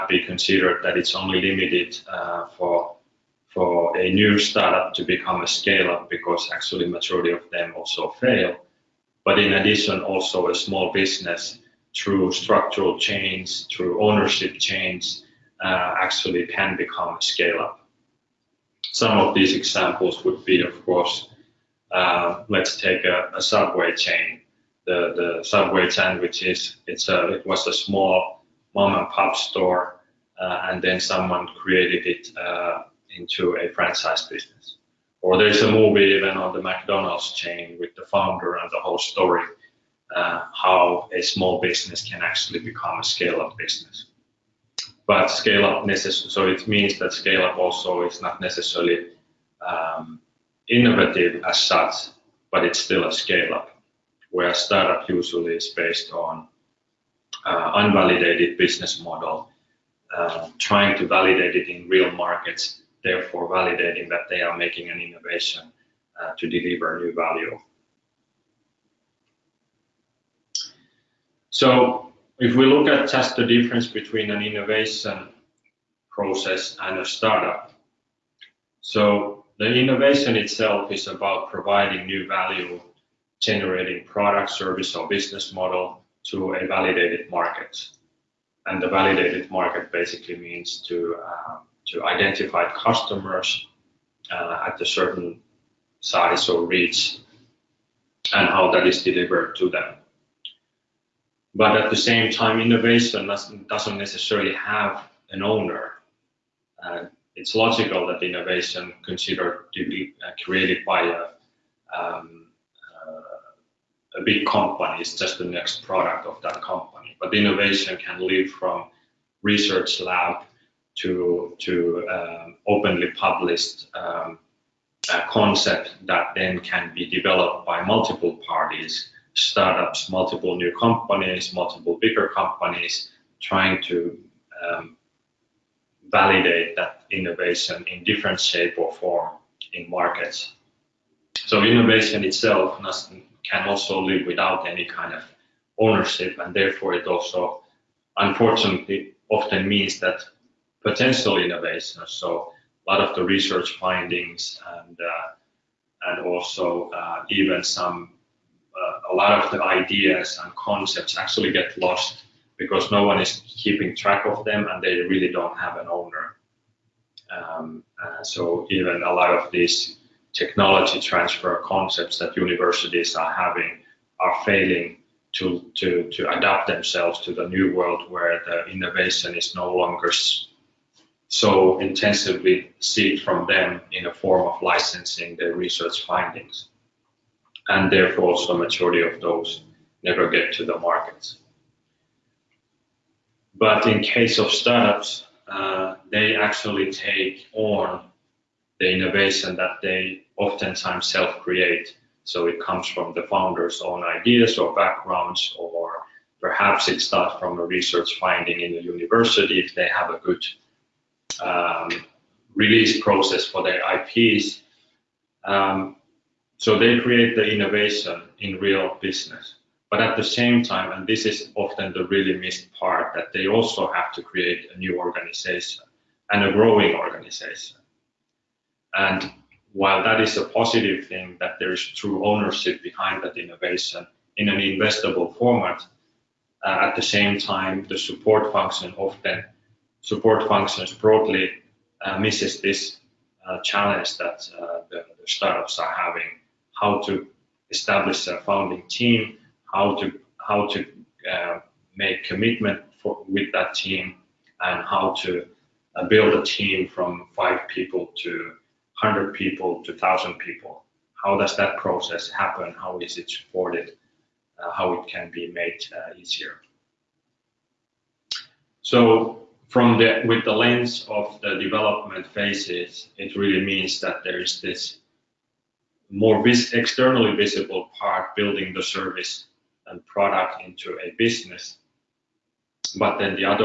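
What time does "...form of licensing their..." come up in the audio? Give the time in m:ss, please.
3:04.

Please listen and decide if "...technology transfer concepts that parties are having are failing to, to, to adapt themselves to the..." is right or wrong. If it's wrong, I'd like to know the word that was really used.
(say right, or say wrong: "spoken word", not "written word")
wrong: "universities", not "parties".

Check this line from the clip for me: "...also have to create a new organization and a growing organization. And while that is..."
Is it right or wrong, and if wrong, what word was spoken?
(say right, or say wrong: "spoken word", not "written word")
right.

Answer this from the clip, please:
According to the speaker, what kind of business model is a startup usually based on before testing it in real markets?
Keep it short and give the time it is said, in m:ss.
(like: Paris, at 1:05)
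Unvalidated, at 0:57.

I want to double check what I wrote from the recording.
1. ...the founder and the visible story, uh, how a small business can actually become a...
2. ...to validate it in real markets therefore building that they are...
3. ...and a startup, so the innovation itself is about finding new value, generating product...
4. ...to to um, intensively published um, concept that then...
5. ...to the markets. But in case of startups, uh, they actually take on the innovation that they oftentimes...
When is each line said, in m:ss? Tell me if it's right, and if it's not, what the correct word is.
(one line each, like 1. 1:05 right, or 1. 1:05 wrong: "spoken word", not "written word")
1. 0:37 wrong: "whole", not "visible"
2. 1:00 wrong: "validating", not "building"
3. 1:16 wrong: "providing", not "finding"
4. 2:00 wrong: "openly", not "intensively"
5. 3:10 right.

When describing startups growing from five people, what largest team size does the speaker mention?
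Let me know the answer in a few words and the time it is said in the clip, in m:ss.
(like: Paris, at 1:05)
1000 people, at 4:19.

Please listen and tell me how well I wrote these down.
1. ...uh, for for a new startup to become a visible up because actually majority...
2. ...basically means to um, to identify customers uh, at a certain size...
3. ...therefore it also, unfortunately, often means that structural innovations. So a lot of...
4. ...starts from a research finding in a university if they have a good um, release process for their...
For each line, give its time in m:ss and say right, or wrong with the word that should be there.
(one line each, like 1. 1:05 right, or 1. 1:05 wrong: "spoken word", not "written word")
1. 0:02 wrong: "scale", not "visible"
2. 1:29 right
3. 2:26 wrong: "potential", not "structural"
4. 3:27 right.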